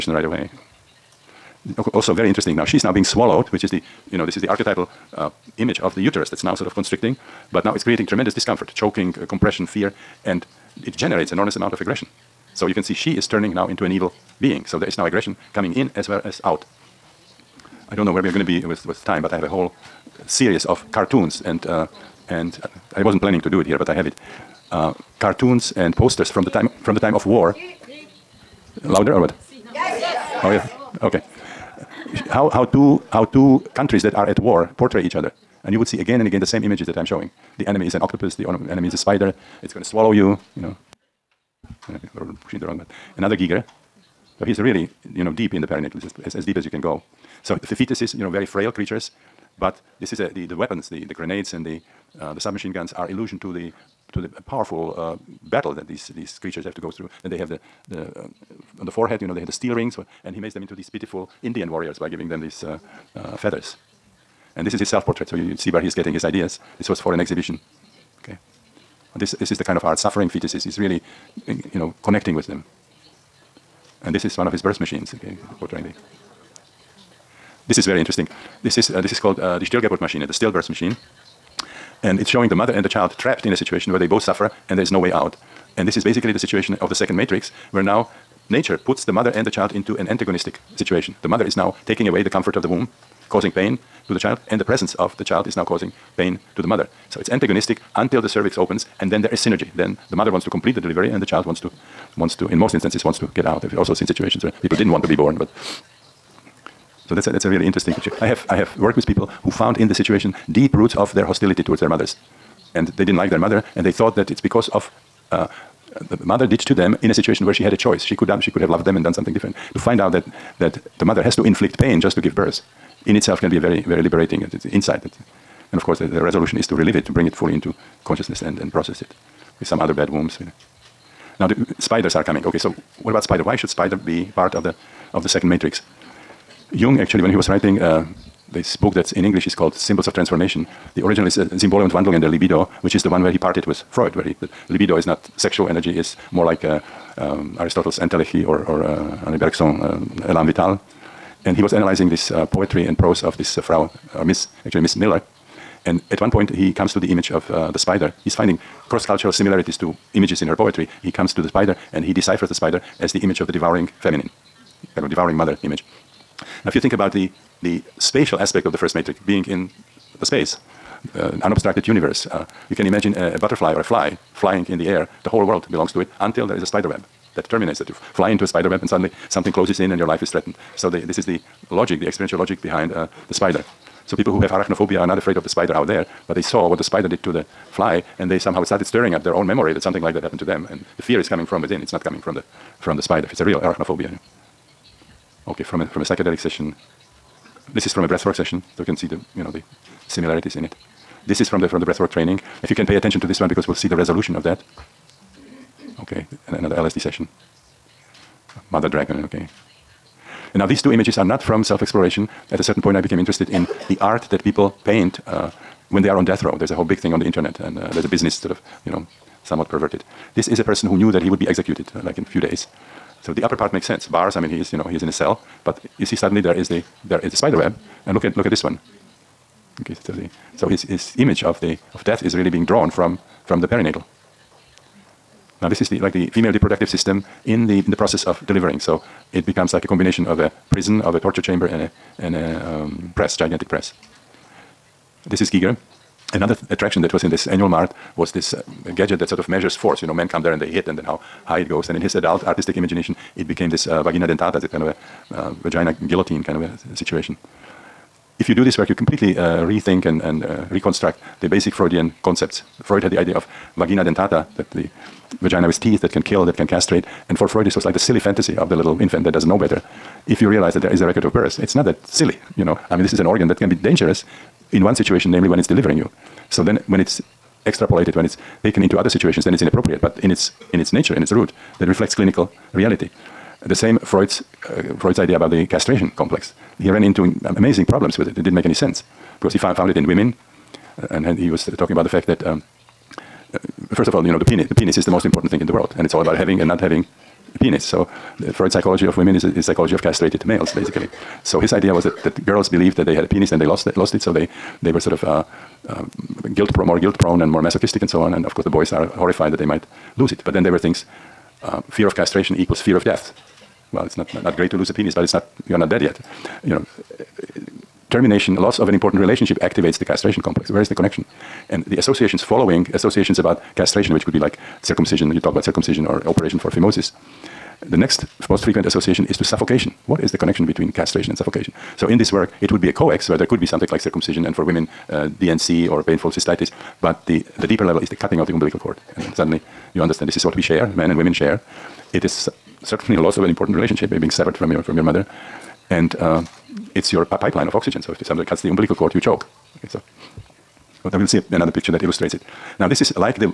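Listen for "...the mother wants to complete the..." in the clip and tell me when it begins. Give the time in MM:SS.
01:40.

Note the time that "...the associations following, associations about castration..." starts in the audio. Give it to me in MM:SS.
05:21.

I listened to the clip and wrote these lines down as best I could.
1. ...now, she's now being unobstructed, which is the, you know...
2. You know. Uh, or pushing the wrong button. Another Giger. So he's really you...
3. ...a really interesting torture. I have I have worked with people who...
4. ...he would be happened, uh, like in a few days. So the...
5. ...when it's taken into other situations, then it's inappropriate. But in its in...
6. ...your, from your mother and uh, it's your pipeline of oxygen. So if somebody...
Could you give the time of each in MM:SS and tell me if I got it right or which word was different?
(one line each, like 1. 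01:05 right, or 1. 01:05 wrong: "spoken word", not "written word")
1. 00:02 wrong: "swallowed", not "unobstructed"
2. 00:40 right
3. 01:47 wrong: "picture", not "torture"
4. 03:41 wrong: "executed", not "happened"
5. 04:38 right
6. 05:44 right.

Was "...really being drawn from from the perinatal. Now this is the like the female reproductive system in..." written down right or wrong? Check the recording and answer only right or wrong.
right.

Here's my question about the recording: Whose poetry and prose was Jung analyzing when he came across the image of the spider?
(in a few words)
Miss Miller.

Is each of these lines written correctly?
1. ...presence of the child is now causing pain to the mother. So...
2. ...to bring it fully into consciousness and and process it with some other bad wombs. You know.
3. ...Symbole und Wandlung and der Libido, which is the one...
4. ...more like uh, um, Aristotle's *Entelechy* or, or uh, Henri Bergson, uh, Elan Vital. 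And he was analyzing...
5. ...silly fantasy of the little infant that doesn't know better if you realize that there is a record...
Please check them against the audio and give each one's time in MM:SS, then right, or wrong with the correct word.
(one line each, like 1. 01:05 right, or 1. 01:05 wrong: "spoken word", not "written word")
1. 01:34 right
2. 02:07 right
3. 02:21 right
4. 02:26 right
5. 04:27 right.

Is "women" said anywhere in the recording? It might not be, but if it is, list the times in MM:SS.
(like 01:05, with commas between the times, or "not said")
04:50, 04:59, 05:34, 05:41.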